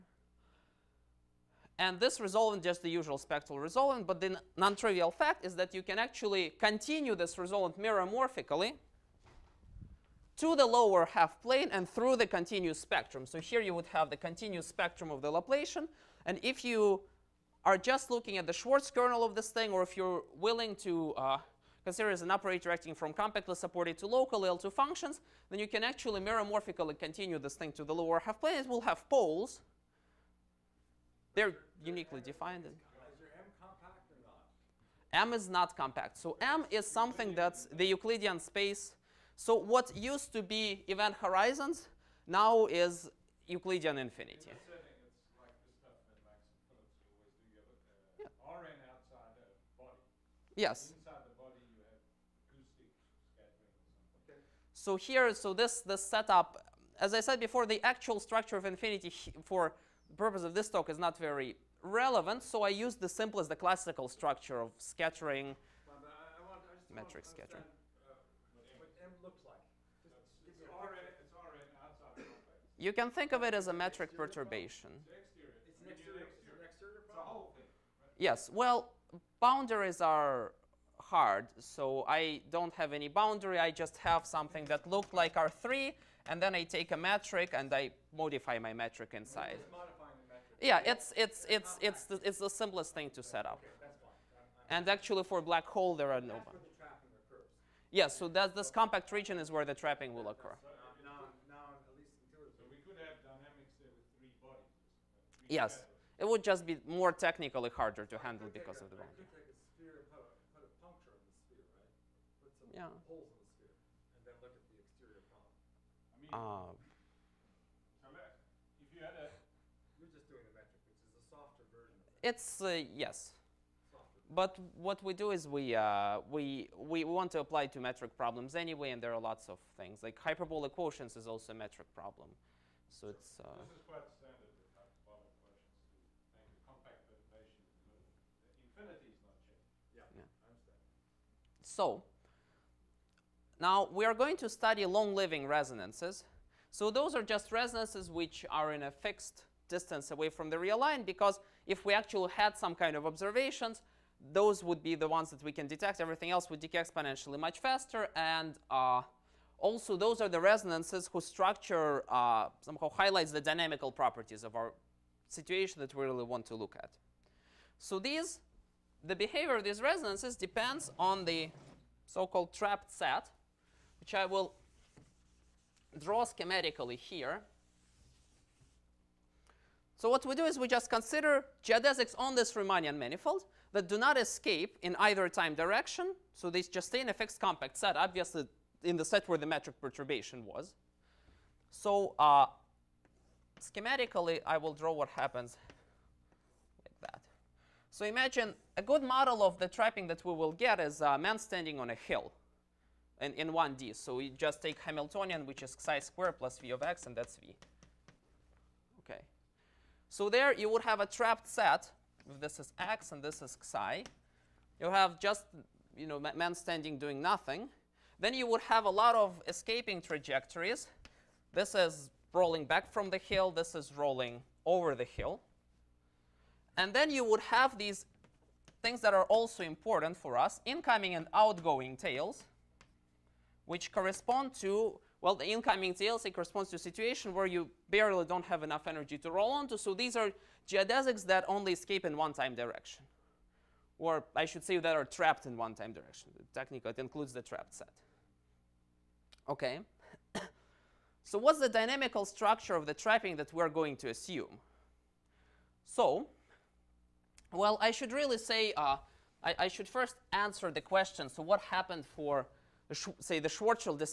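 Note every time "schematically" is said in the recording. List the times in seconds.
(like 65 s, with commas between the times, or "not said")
176 s, 193 s.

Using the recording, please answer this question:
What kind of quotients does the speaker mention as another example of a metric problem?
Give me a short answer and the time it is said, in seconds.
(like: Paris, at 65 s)
Hyperbolic quotients, at 130 s.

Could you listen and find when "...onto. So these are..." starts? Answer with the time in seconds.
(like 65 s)
239 s.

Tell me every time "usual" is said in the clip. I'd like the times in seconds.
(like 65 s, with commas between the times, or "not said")
2 s.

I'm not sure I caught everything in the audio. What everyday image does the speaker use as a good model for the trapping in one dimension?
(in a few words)
A man standing on a hill.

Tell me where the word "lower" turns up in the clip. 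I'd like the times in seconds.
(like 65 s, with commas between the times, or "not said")
10 s, 27 s.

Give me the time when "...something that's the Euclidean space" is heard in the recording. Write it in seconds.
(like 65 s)
36 s.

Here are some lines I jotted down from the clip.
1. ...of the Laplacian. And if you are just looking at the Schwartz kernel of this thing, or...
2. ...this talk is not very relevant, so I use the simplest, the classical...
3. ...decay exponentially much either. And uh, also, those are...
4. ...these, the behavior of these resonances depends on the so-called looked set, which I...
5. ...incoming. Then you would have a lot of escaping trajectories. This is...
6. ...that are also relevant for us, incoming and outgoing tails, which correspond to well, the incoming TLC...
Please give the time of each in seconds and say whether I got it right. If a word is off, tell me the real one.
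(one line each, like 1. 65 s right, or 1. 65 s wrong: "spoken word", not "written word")
1. 15 s right
2. 60 s right
3. 156 s wrong: "faster", not "either"
4. 167 s wrong: "trapped", not "looked"
5. 217 s wrong: "nothing", not "incoming"
6. 229 s wrong: "important", not "relevant".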